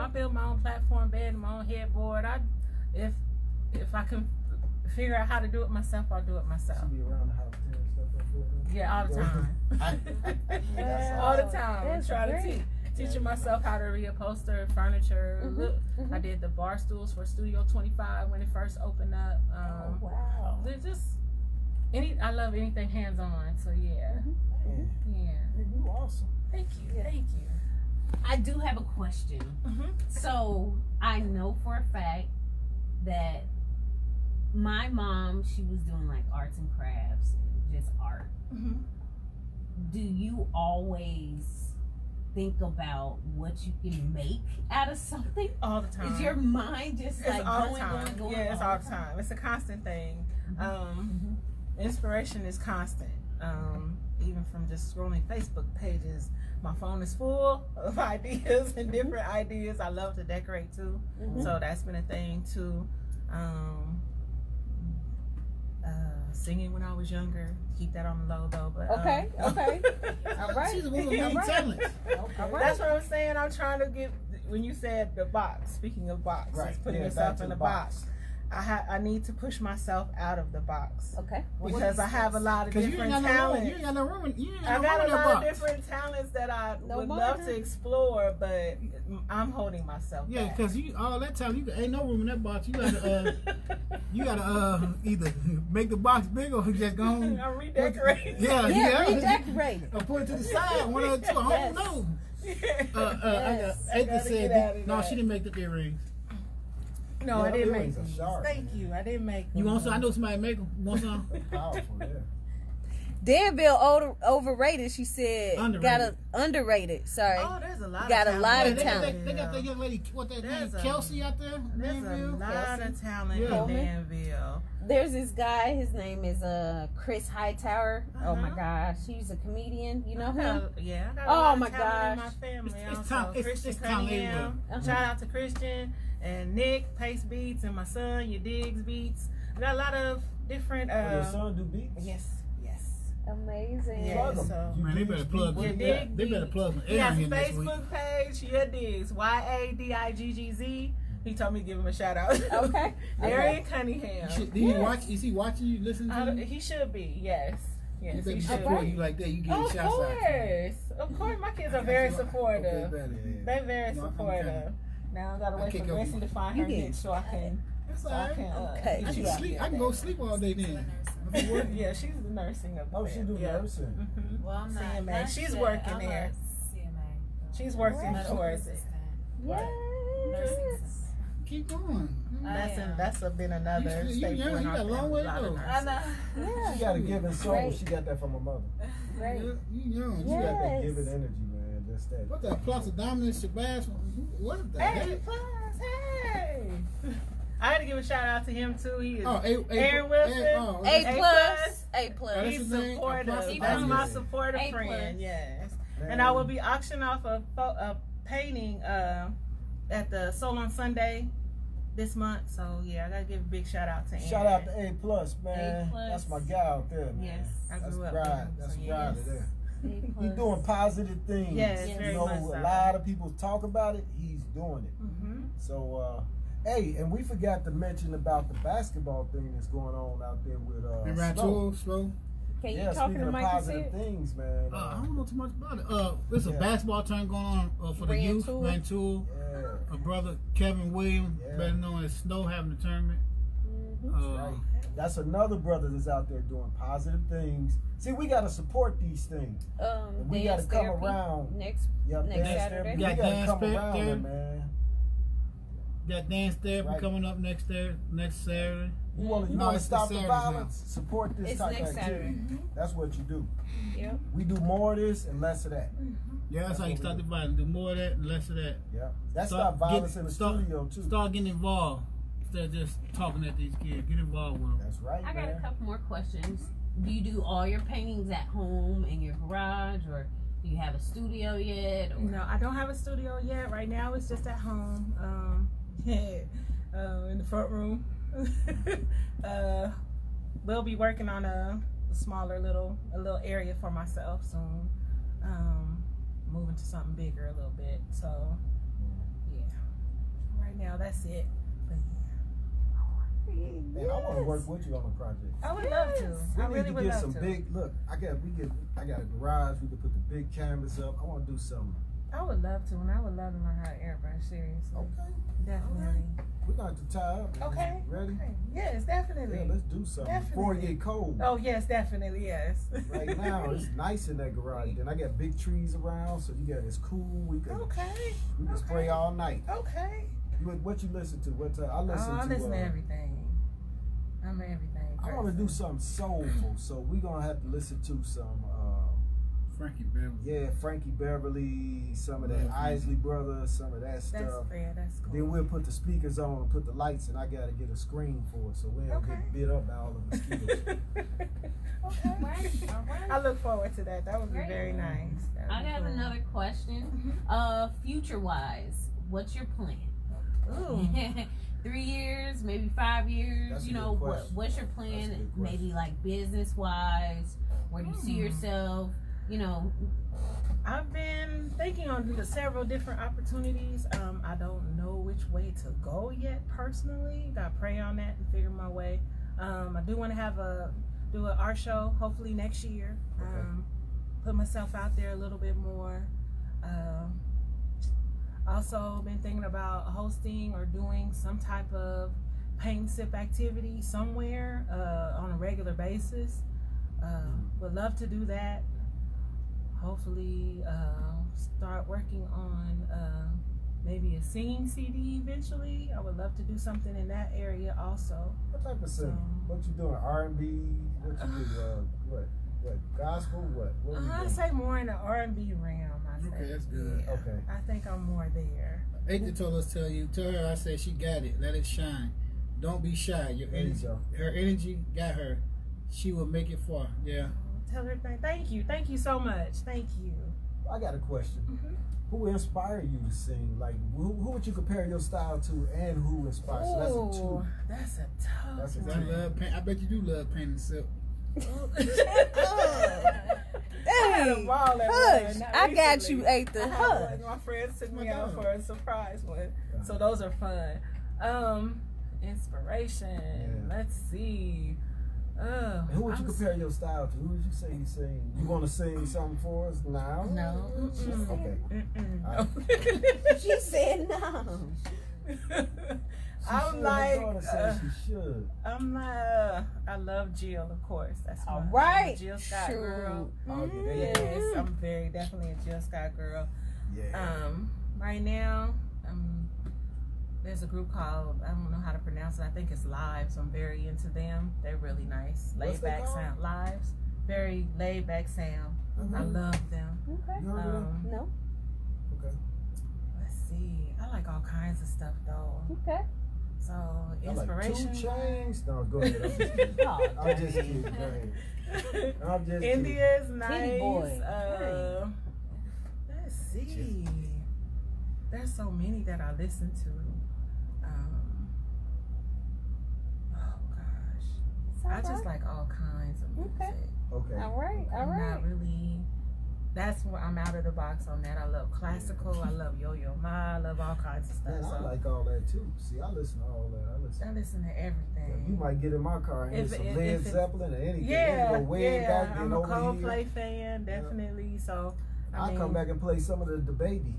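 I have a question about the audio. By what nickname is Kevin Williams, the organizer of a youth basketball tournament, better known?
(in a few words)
Snow.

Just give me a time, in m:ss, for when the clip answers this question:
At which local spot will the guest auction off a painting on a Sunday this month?
3:30.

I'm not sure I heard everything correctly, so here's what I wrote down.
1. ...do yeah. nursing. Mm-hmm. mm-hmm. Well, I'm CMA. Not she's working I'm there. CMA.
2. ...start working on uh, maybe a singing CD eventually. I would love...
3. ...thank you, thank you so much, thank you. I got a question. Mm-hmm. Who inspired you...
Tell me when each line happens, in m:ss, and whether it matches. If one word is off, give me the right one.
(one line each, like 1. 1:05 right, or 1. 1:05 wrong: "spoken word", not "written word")
1. 2:53 right
2. 6:41 right
3. 7:08 right.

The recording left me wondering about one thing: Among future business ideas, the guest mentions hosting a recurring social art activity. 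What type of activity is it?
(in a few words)
paint sip.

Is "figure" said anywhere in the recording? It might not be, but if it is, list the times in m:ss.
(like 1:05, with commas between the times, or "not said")
0:04, 6:18.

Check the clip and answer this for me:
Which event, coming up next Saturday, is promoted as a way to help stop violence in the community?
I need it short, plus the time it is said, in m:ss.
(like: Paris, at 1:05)
Dance therapy, at 4:12.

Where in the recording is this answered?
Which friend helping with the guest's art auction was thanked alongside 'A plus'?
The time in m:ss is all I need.
3:19.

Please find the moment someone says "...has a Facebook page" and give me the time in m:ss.
2:26.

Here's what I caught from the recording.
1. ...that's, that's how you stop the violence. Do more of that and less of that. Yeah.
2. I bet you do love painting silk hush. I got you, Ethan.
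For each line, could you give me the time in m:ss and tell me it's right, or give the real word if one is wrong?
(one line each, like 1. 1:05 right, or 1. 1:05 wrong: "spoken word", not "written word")
1. 4:26 right
2. 7:19 right.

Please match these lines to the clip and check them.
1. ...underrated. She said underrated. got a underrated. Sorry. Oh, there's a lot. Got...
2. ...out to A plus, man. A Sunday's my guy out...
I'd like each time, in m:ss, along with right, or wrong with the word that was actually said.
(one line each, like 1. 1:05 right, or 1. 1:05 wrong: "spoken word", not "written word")
1. 1:54 wrong: "overrated", not "underrated"
2. 3:34 wrong: "That", not "Sunday".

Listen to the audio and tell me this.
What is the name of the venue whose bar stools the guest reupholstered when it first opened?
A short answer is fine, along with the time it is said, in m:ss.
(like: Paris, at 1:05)
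Studio 25, at 0:17.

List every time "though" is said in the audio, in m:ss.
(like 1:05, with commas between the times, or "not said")
1:08, 8:15.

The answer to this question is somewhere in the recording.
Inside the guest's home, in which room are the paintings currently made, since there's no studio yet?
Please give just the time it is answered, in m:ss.
4:47.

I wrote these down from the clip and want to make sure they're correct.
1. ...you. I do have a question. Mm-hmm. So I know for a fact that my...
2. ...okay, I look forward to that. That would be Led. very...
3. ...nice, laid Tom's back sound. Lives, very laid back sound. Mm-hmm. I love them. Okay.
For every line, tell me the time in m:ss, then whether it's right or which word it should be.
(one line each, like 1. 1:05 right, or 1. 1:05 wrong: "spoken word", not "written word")
1. 0:27 right
2. 5:52 wrong: "Great", not "Led"
3. 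8:05 wrong: "What", not "Tom".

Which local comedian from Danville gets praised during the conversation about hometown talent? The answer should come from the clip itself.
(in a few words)
Chris Hightower.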